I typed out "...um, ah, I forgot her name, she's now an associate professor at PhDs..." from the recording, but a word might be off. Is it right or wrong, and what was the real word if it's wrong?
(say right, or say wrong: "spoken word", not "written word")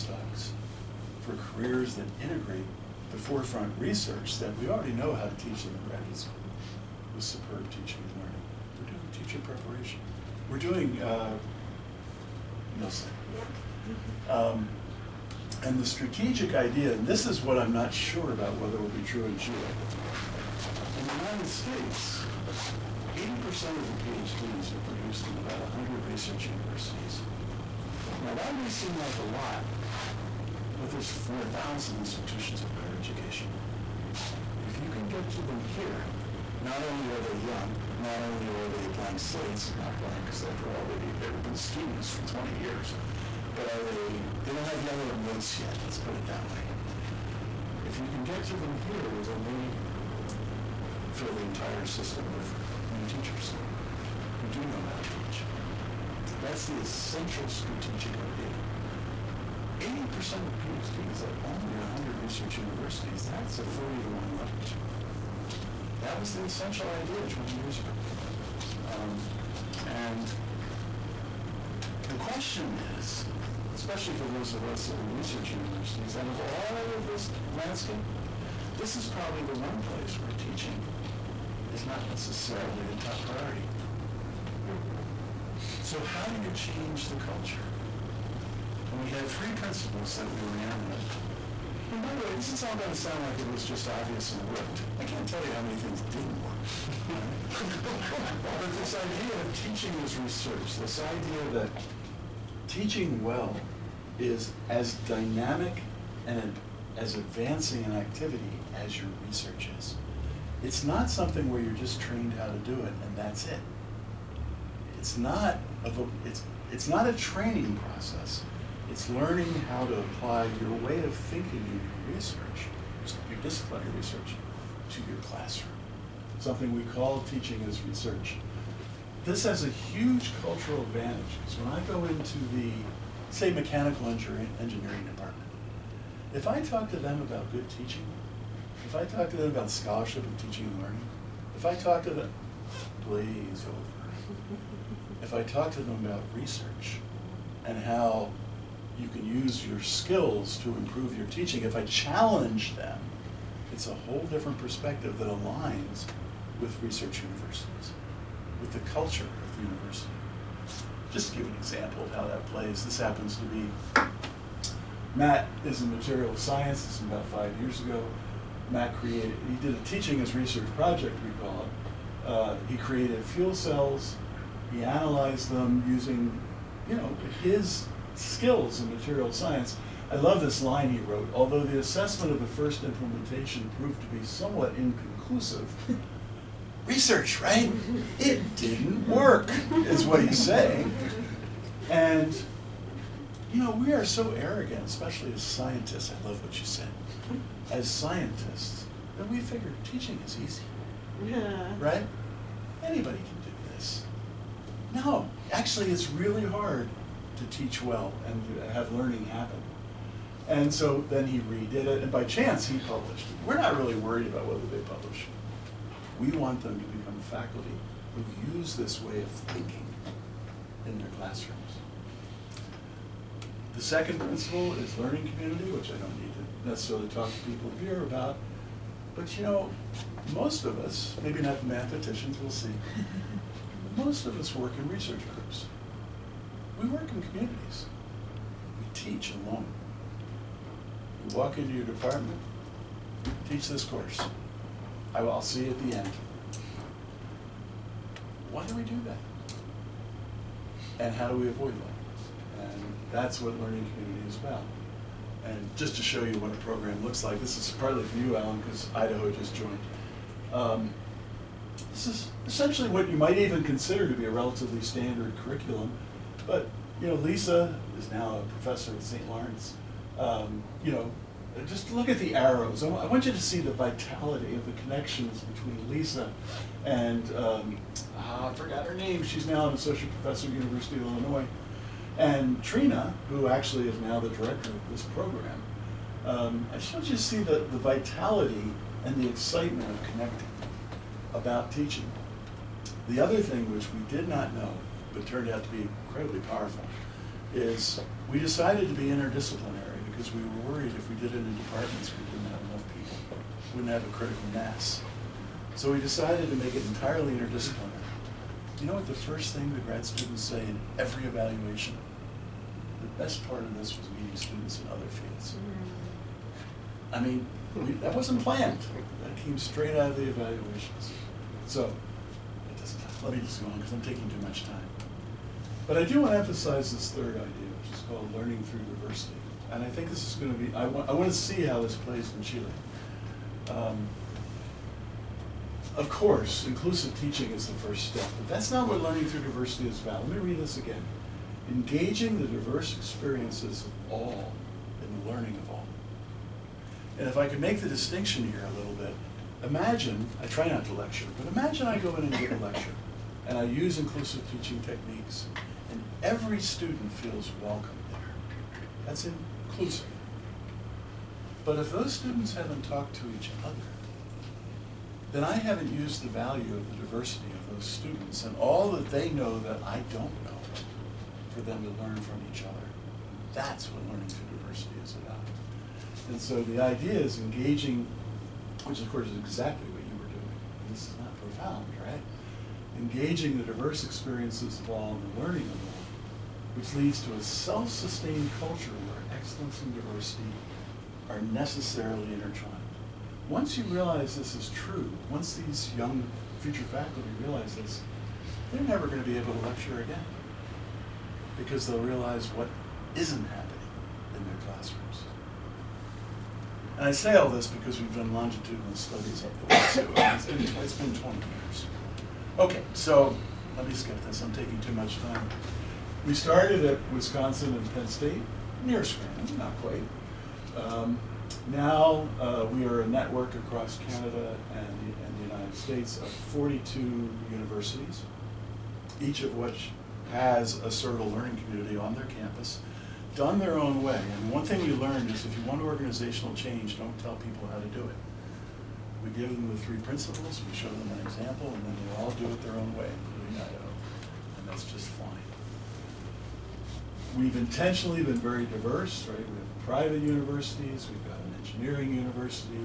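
wrong: "University", not "PhDs".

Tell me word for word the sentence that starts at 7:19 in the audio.
We give them the three principles, we show them an example, and then they all do it their own way, including IO.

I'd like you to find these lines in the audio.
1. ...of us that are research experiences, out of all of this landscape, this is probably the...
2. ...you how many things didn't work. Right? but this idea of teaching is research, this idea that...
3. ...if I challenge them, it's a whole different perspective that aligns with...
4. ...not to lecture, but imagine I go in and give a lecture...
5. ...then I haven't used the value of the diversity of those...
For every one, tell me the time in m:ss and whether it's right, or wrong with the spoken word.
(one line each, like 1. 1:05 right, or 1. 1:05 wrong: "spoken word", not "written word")
1. 1:14 wrong: "universities", not "experiences"
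2. 1:35 right
3. 2:31 right
4. 5:50 right
5. 6:05 right.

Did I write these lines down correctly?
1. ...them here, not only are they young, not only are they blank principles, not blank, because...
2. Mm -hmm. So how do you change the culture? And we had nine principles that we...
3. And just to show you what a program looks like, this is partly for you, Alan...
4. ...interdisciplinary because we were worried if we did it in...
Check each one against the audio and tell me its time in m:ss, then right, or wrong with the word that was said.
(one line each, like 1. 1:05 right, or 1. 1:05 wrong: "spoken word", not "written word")
1. 0:35 wrong: "slates", not "principles"
2. 1:24 wrong: "three", not "nine"
3. 4:15 right
4. 4:59 right.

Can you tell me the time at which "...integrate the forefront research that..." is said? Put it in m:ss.
0:02.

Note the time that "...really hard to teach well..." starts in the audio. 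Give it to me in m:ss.
3:26.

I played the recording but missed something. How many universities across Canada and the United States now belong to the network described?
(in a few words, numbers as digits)
42.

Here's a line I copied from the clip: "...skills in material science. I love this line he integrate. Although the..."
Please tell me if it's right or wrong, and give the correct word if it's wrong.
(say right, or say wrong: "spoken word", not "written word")
wrong: "wrote", not "integrate".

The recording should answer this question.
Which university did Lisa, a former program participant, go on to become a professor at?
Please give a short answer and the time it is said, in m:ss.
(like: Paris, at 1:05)
St. Lawrence, at 4:29.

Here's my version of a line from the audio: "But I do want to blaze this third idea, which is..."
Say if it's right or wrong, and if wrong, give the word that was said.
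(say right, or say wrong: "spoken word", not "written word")
wrong: "emphasize", not "blaze".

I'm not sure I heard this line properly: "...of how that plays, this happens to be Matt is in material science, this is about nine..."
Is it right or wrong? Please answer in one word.
wrong.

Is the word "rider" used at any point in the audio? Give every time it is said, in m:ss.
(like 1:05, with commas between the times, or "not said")
not said.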